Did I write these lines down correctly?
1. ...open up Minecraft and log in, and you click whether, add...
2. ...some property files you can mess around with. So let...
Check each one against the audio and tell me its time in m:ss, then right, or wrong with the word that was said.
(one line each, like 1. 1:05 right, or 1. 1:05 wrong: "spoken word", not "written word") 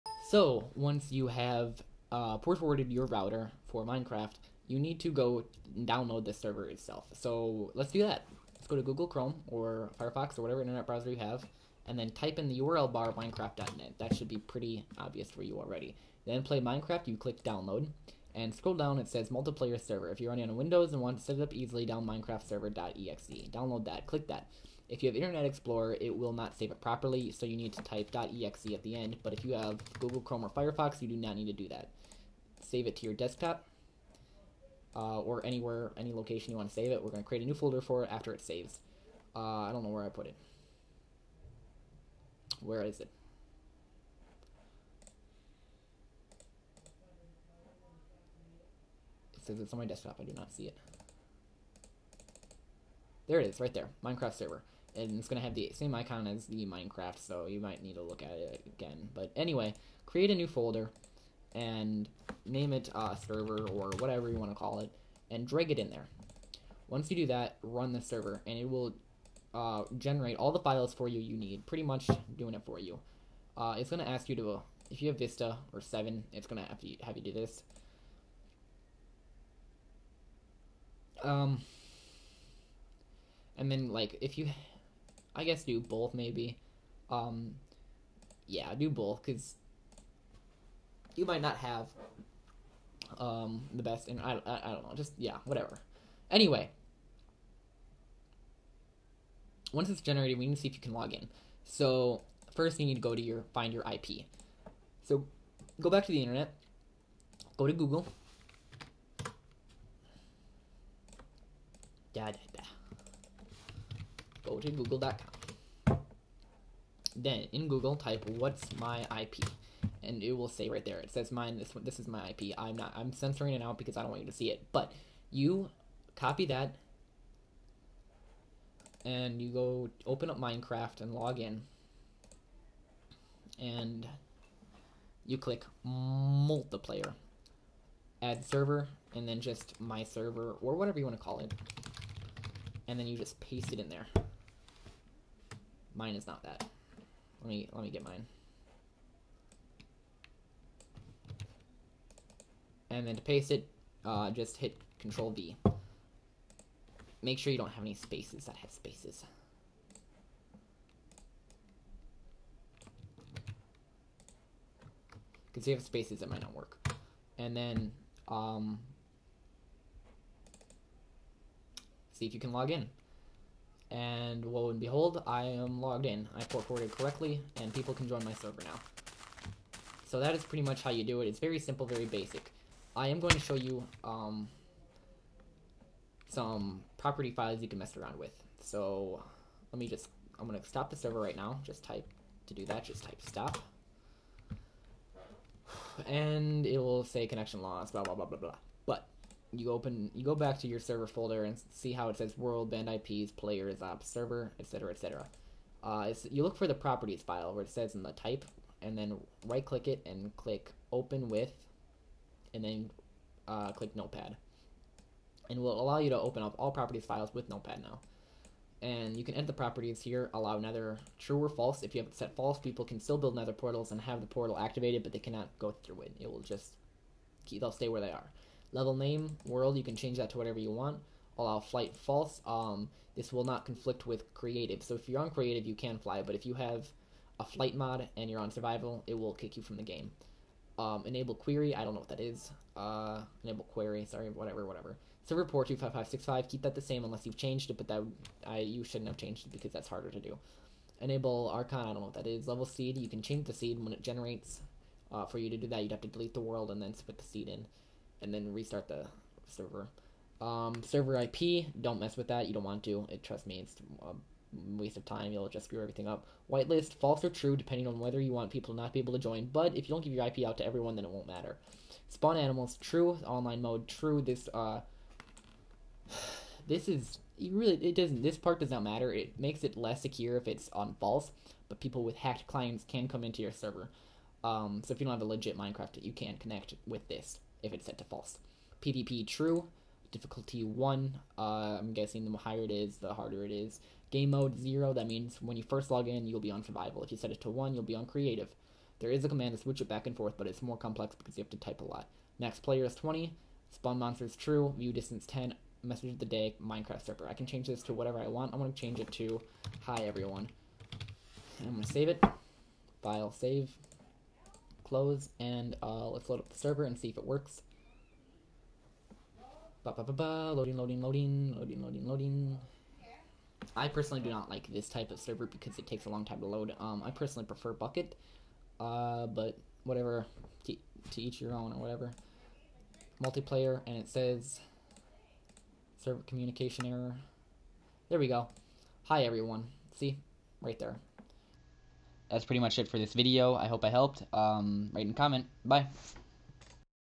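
1. 2:10 wrong: "multiplayer", not "whether"
2. 3:06 right.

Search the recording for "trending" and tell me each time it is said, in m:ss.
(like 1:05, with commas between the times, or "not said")
not said.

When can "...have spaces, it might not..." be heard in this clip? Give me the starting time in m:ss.
2:45.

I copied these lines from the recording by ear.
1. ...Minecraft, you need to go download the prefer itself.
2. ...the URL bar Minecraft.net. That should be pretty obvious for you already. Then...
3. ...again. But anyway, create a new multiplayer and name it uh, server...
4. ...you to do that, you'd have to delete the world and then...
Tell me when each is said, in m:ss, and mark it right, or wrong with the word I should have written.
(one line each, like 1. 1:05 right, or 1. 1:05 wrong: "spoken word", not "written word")
1. 0:03 wrong: "server", not "prefer"
2. 0:12 right
3. 0:58 wrong: "folder", not "multiplayer"
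4. 4:15 right.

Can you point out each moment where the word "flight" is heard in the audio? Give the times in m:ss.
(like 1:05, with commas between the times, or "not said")
3:51, 3:57.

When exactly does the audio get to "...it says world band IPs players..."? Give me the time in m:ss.
3:22.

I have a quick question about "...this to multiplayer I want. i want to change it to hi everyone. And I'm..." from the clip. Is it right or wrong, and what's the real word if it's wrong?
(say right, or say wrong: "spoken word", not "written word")
wrong: "whatever", not "multiplayer".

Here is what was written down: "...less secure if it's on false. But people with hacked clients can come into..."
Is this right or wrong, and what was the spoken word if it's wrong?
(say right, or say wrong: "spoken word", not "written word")
right.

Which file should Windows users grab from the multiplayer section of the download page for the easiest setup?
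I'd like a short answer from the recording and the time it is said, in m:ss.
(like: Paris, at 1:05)
minecraftserver.exe, at 0:22.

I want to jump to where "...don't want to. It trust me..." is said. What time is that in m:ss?
4:22.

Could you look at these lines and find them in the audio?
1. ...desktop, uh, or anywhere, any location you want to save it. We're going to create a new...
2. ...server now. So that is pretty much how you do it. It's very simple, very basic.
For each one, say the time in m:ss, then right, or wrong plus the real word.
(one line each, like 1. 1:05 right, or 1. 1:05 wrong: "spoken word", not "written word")
1. 0:33 right
2. 2:58 right.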